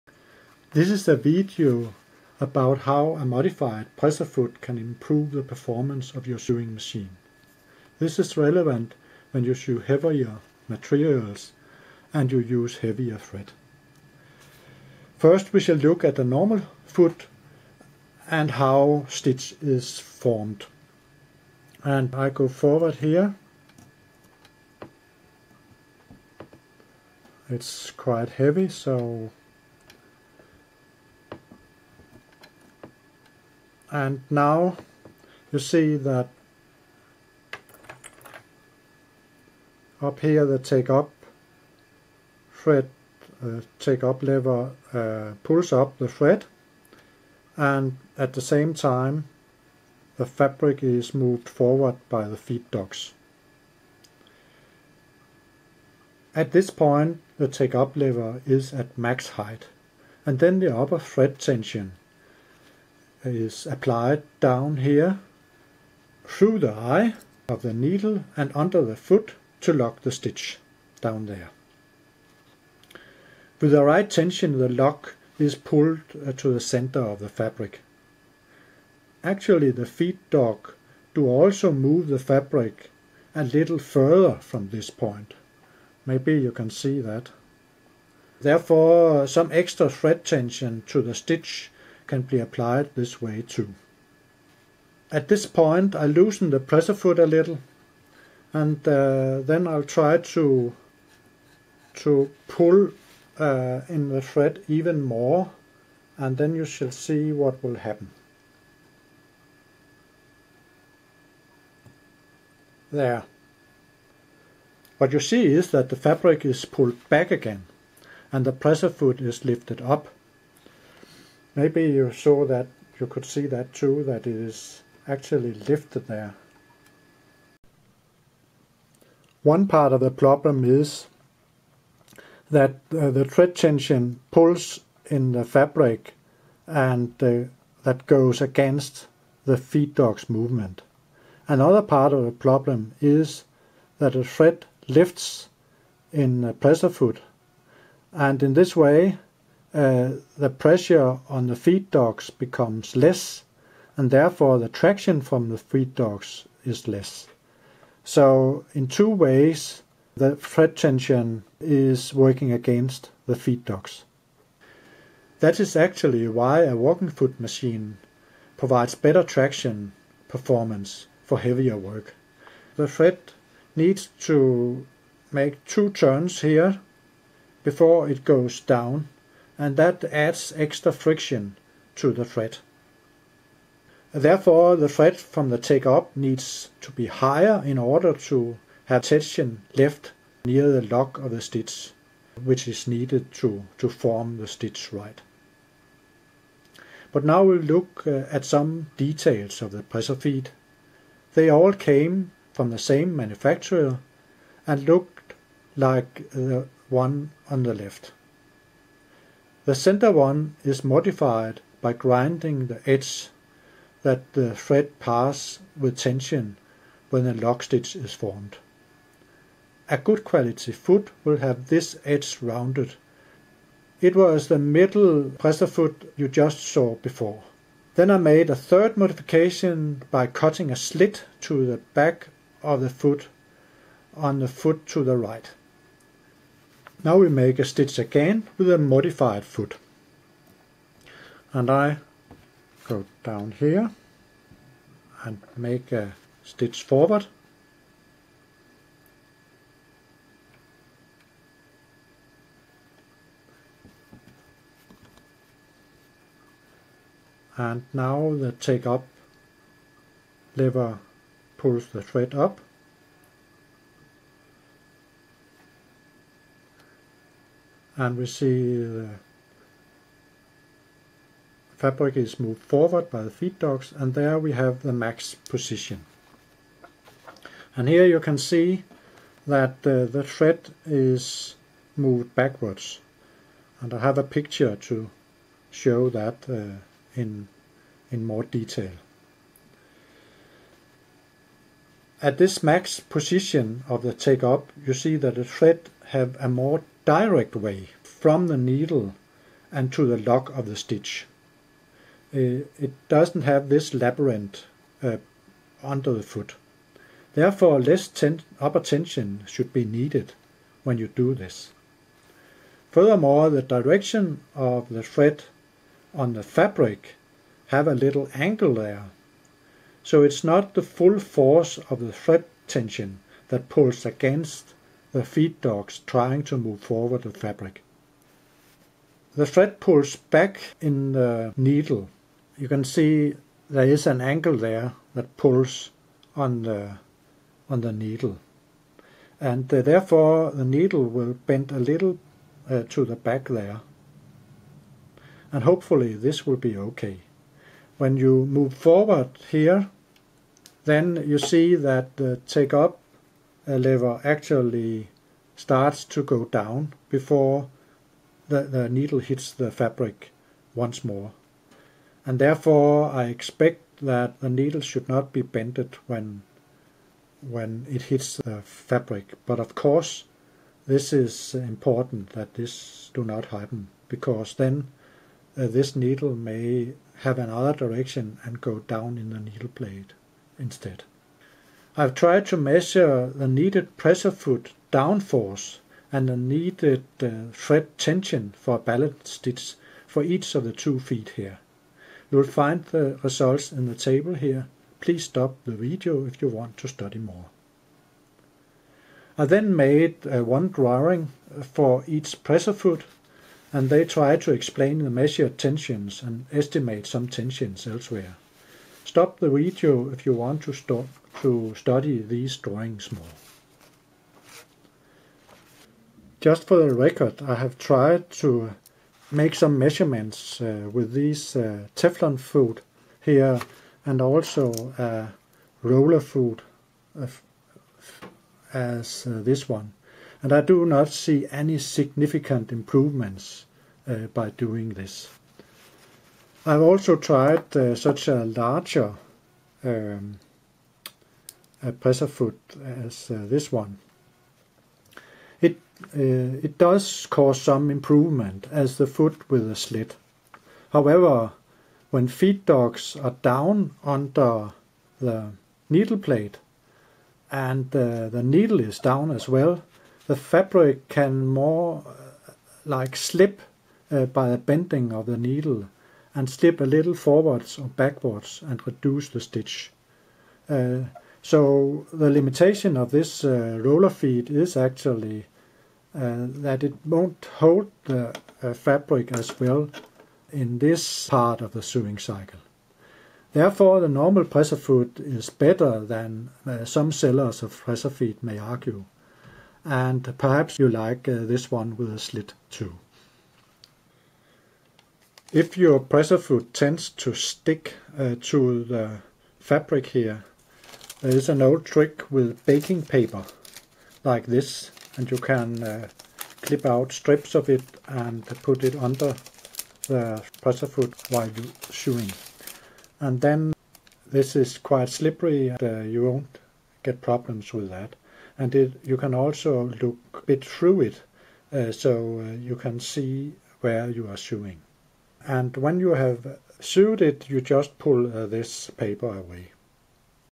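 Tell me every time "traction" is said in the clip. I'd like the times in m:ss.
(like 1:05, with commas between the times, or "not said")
2:34, 2:49.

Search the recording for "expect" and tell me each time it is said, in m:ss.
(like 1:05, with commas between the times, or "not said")
6:03.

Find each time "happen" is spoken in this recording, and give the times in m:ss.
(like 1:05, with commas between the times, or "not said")
1:47, 6:13.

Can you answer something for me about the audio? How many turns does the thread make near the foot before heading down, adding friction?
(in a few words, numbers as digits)
2.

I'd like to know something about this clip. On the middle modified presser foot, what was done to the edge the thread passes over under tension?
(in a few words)
Grinding.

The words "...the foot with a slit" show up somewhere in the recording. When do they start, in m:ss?
7:28.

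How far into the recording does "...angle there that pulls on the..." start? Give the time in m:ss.
5:34.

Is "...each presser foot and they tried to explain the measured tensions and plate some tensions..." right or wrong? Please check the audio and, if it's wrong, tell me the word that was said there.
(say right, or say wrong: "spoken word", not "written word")
wrong: "estimate", not "plate".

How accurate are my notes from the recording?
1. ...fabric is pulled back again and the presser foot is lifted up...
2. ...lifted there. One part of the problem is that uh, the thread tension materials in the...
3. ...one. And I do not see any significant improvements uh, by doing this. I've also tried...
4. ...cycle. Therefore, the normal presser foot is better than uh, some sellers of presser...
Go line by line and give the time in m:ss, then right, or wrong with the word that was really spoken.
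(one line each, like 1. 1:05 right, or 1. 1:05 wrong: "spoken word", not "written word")
1. 1:56 right
2. 2:05 wrong: "pulls", not "materials"
3. 7:09 right
4. 8:02 right.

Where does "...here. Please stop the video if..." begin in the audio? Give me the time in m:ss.
6:34.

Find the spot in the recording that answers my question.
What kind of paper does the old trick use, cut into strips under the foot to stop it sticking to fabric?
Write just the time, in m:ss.
8:22.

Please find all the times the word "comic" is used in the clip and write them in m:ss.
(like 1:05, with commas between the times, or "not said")
not said.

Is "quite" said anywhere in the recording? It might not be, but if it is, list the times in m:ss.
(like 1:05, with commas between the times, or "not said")
0:27, 8:34.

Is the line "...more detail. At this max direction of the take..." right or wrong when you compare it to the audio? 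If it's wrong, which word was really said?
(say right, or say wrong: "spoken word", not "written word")
wrong: "position", not "direction".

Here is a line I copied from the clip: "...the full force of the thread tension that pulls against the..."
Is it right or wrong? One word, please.
right.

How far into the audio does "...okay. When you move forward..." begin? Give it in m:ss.
5:46.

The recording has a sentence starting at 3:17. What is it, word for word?
But now we'll look uh, at some details of the presser feet.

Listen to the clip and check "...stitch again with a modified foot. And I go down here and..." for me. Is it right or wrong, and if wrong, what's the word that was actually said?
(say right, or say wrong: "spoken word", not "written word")
right.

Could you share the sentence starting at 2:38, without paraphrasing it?
So in two ways the thread tension is working against the feed dogs.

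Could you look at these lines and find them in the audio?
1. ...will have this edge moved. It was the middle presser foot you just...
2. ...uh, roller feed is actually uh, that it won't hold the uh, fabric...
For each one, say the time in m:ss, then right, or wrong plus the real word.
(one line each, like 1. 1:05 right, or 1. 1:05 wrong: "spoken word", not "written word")
1. 3:41 wrong: "rounded", not "moved"
2. 7:53 right.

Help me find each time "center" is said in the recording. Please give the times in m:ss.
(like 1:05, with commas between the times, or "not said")
1:16, 3:29.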